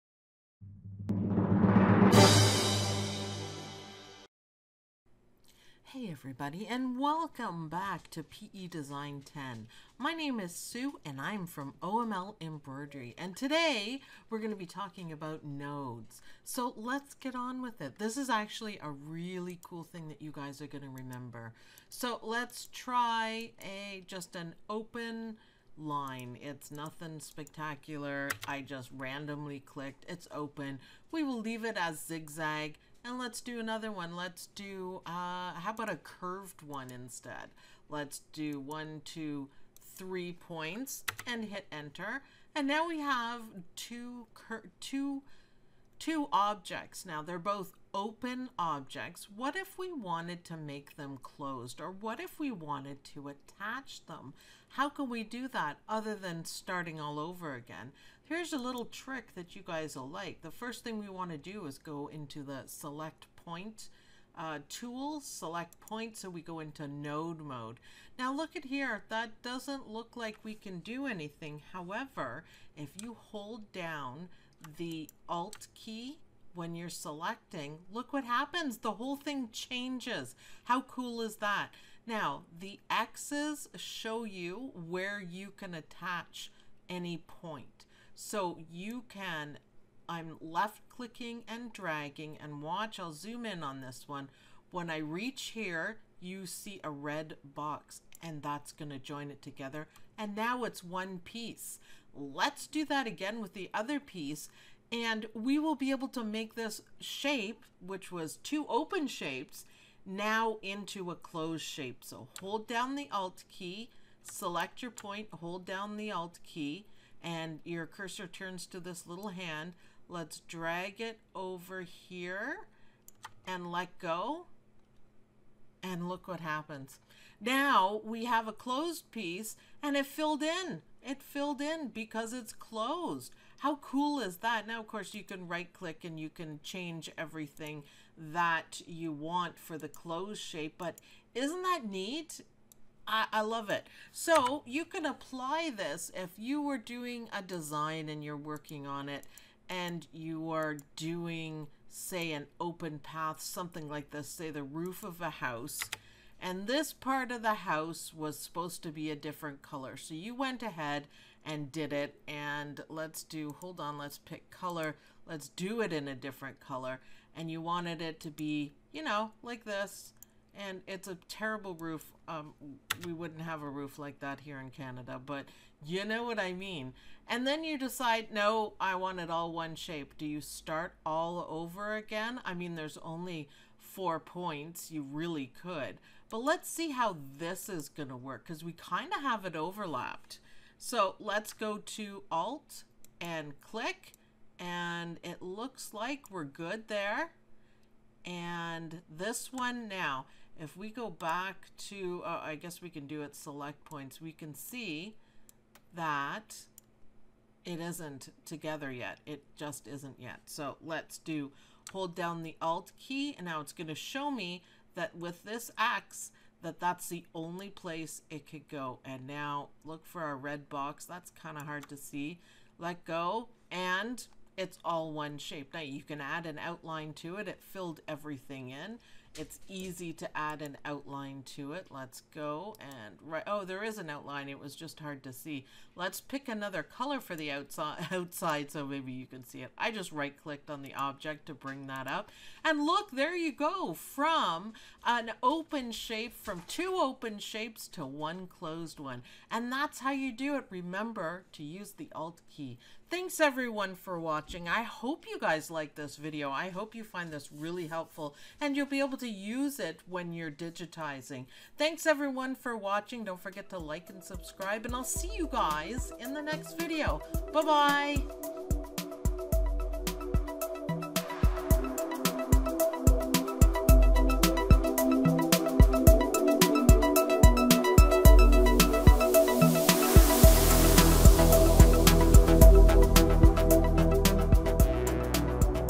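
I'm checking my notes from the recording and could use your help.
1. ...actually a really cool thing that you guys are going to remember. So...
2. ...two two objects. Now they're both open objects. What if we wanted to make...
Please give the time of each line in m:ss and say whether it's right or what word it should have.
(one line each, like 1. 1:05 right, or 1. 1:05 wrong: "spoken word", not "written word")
1. 0:18 right
2. 0:44 right.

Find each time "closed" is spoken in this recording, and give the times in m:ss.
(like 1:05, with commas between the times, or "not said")
0:51, 1:51, 2:08, 2:12, 2:19, 4:08.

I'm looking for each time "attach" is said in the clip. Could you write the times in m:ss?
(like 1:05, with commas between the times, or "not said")
0:53, 1:25.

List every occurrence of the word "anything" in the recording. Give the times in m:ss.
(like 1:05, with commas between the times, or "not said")
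1:11.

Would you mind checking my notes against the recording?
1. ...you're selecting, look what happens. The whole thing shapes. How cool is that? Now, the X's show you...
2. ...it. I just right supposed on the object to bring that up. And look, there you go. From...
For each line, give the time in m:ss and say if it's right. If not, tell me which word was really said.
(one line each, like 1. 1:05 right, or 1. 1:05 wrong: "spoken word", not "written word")
1. 1:16 wrong: "changes", not "shapes"
2. 3:59 wrong: "clicked", not "supposed".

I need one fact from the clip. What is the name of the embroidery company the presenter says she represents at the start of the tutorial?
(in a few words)
OML Embroidery.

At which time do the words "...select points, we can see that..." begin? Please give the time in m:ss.
3:23.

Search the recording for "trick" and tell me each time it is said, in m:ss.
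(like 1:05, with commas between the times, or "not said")
0:58.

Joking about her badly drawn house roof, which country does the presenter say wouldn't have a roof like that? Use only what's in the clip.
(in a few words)
Canada.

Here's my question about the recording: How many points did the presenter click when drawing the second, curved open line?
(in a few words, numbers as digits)
3.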